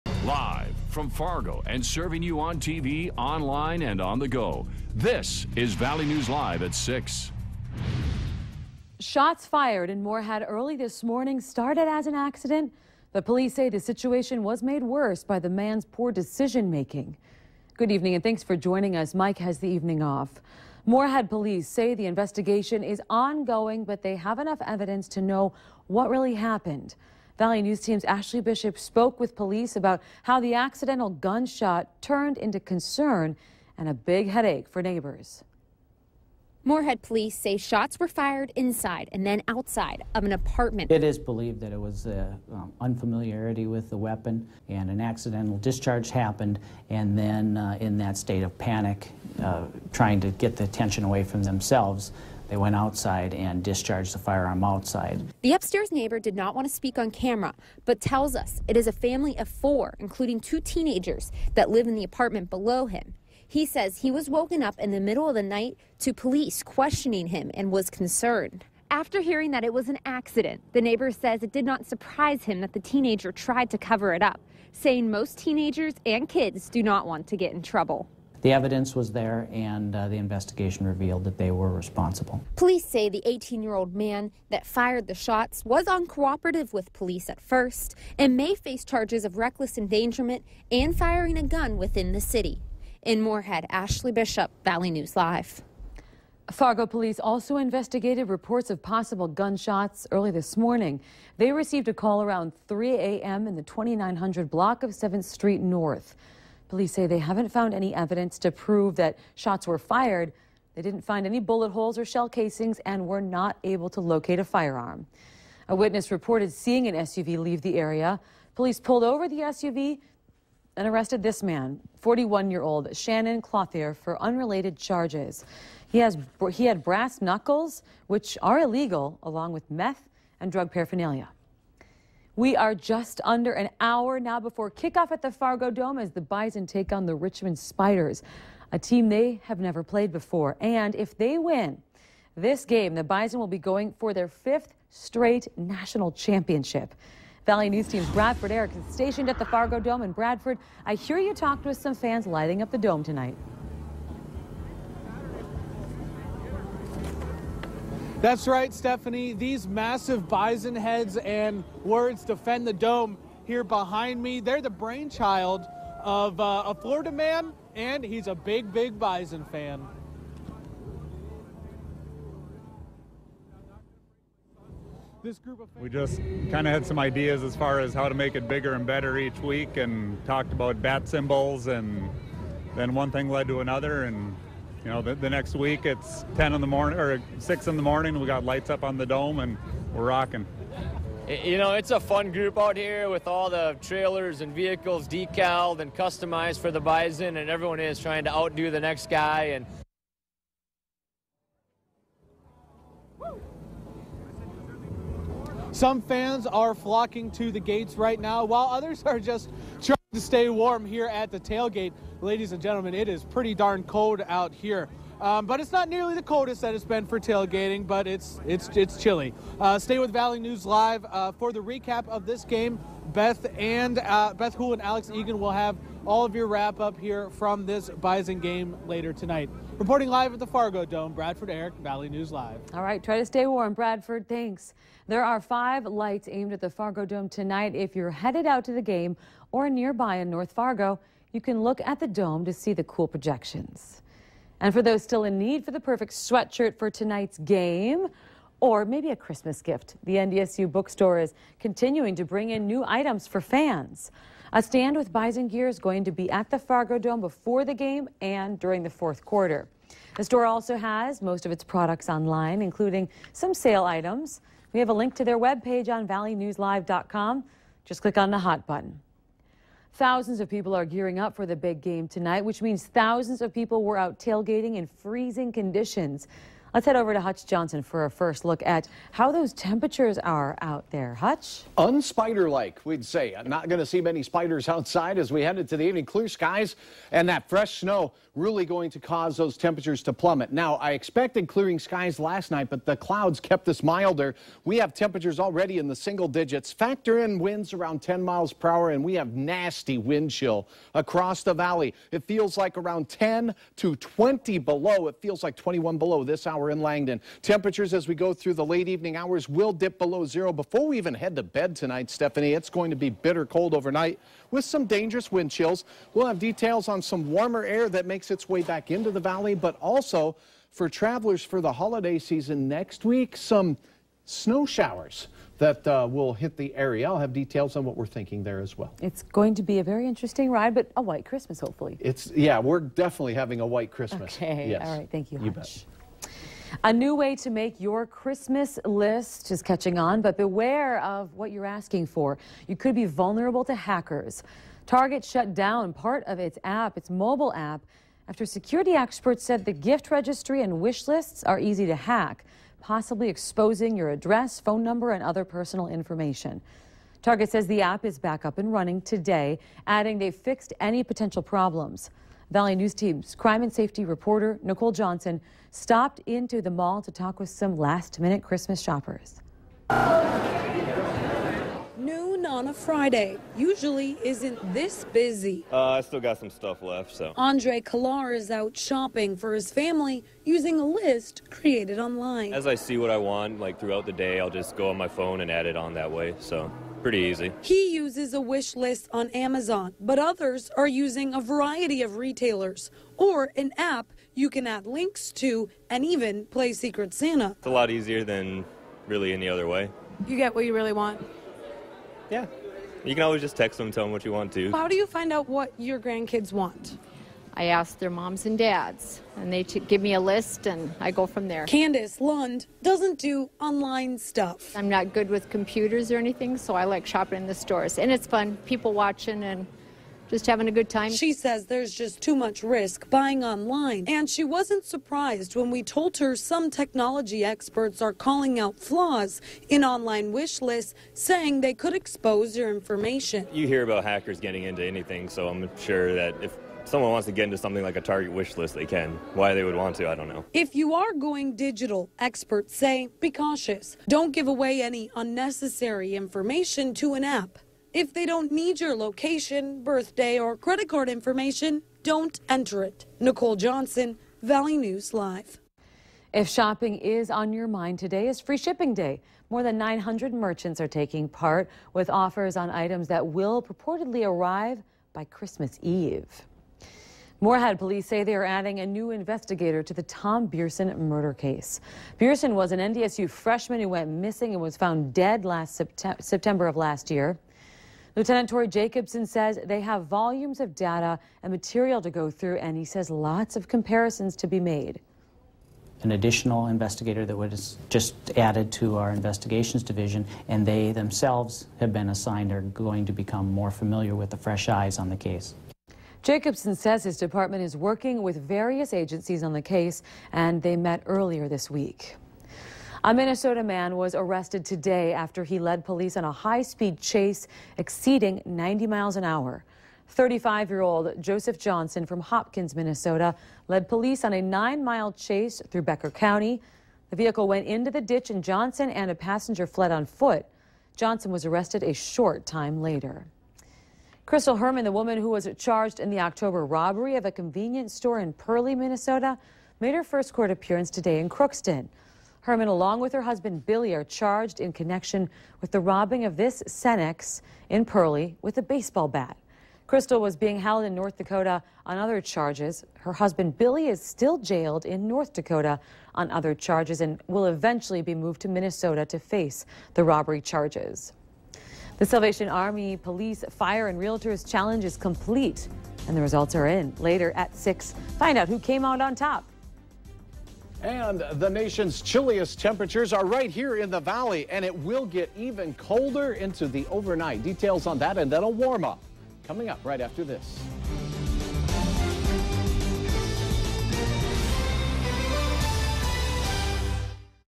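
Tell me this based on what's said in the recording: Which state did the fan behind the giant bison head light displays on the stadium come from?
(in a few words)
Florida.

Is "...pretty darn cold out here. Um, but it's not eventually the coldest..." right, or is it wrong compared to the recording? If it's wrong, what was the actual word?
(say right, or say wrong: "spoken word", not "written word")
wrong: "nearly", not "eventually".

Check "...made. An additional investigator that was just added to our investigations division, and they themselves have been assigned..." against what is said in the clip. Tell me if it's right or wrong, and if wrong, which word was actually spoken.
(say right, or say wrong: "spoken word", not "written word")
right.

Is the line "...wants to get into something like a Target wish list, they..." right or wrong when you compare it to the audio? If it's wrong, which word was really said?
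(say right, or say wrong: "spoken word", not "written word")
right.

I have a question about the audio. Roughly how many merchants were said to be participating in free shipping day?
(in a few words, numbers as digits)
900.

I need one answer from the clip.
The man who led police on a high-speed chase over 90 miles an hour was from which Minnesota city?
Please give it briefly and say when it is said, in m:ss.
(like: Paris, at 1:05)
Hopkins, at 8:32.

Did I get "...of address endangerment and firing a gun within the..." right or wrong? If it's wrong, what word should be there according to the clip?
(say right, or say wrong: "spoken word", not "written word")
wrong: "reckless", not "address".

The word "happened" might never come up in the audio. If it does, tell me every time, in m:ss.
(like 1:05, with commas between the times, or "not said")
0:26, 0:46.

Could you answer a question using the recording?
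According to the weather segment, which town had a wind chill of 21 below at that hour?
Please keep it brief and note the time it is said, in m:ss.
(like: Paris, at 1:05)
Langdon, at 5:06.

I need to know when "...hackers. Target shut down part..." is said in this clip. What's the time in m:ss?
5:43.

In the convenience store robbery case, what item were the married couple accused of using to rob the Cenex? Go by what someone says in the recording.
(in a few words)
baseball bat.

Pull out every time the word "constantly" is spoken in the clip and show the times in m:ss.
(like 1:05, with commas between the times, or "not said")
not said.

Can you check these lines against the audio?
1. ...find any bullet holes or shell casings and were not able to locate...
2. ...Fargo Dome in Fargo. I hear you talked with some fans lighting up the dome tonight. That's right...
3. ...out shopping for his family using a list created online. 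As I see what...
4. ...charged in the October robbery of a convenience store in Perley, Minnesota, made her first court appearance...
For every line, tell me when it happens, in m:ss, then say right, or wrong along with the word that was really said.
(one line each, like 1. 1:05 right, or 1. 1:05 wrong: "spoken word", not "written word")
1. 1:51 right
2. 2:29 wrong: "Bradford", not "Fargo"
3. 6:18 right
4. 8:45 right.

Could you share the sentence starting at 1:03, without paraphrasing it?
He says he was woken up in the middle of the night to police questioning him and was concerned.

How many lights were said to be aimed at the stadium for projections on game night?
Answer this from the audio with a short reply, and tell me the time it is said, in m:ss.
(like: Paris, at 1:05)
5, at 3:55.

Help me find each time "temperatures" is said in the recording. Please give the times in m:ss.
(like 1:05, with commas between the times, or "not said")
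4:39, 4:49, 4:54, 5:07, 9:22.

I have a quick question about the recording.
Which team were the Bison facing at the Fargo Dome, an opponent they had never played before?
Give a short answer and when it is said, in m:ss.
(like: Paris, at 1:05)
Richmond Spiders, at 2:17.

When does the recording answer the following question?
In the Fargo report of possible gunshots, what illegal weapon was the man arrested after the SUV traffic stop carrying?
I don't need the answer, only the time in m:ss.
2:06.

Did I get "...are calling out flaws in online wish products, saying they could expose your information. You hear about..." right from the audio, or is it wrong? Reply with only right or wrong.
wrong.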